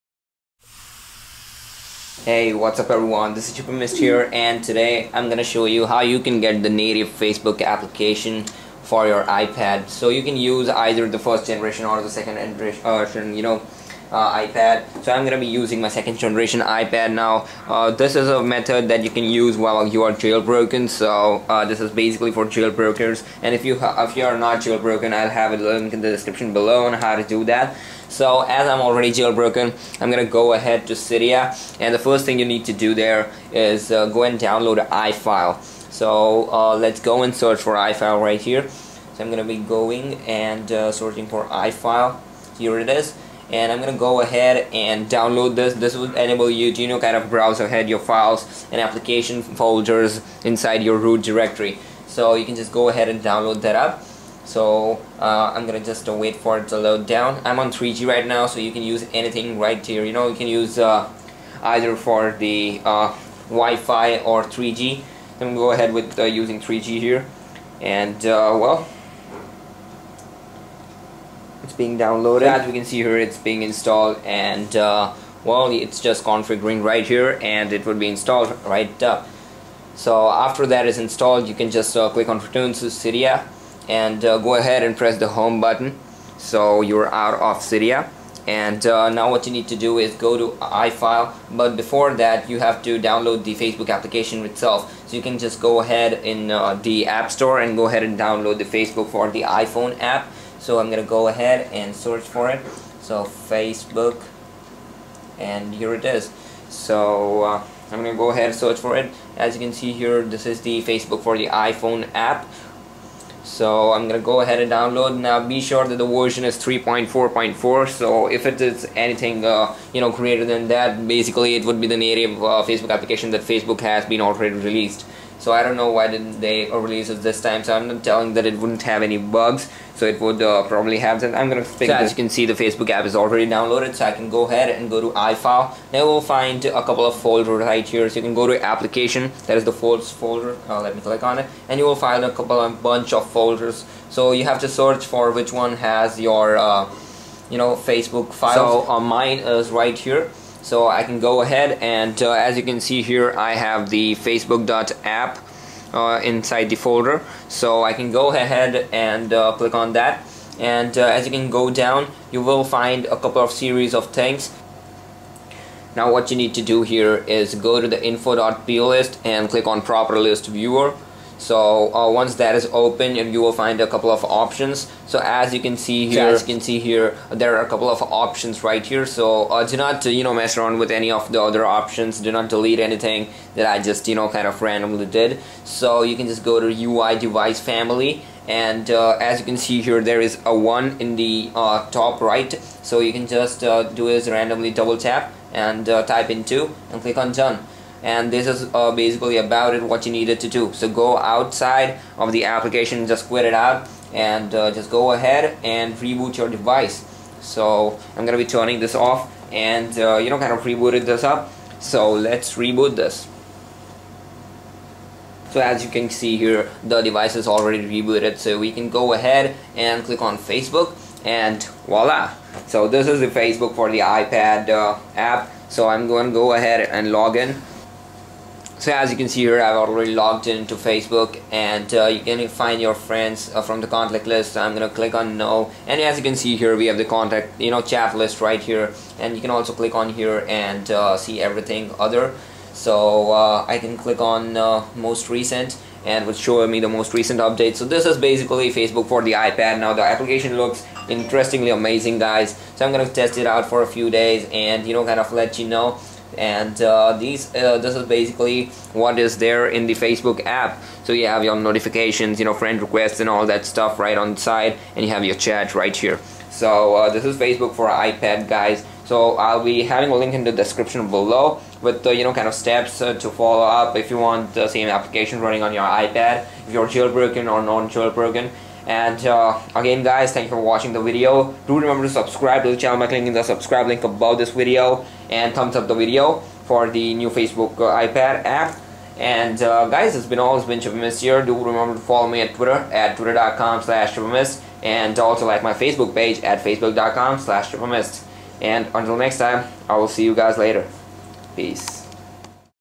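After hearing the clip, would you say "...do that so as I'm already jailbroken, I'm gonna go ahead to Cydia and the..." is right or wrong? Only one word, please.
right.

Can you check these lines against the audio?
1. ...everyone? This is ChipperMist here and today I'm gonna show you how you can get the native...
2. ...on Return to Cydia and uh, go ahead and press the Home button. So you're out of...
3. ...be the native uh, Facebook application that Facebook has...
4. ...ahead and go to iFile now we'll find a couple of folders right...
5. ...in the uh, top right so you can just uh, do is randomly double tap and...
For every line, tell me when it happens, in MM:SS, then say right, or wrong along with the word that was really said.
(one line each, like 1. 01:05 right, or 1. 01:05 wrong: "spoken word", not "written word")
1. 00:02 right
2. 01:22 right
3. 02:01 right
4. 02:14 right
5. 03:10 right.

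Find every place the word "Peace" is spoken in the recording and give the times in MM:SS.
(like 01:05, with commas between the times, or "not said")
05:01.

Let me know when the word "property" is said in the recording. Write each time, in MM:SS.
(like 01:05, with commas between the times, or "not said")
02:49.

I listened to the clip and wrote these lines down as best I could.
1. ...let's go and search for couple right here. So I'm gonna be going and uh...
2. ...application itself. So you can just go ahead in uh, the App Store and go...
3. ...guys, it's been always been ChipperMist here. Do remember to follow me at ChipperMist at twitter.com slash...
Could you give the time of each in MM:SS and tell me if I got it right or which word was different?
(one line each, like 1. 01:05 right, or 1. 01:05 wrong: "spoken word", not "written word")
1. 00:36 wrong: "iFile", not "couple"
2. 01:33 right
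3. 04:49 wrong: "Twitter", not "ChipperMist".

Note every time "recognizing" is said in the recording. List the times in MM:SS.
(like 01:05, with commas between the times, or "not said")
not said.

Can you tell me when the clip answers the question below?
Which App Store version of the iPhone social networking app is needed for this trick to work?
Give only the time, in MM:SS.
01:56.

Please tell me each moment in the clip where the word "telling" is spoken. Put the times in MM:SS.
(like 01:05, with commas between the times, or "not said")
02:08.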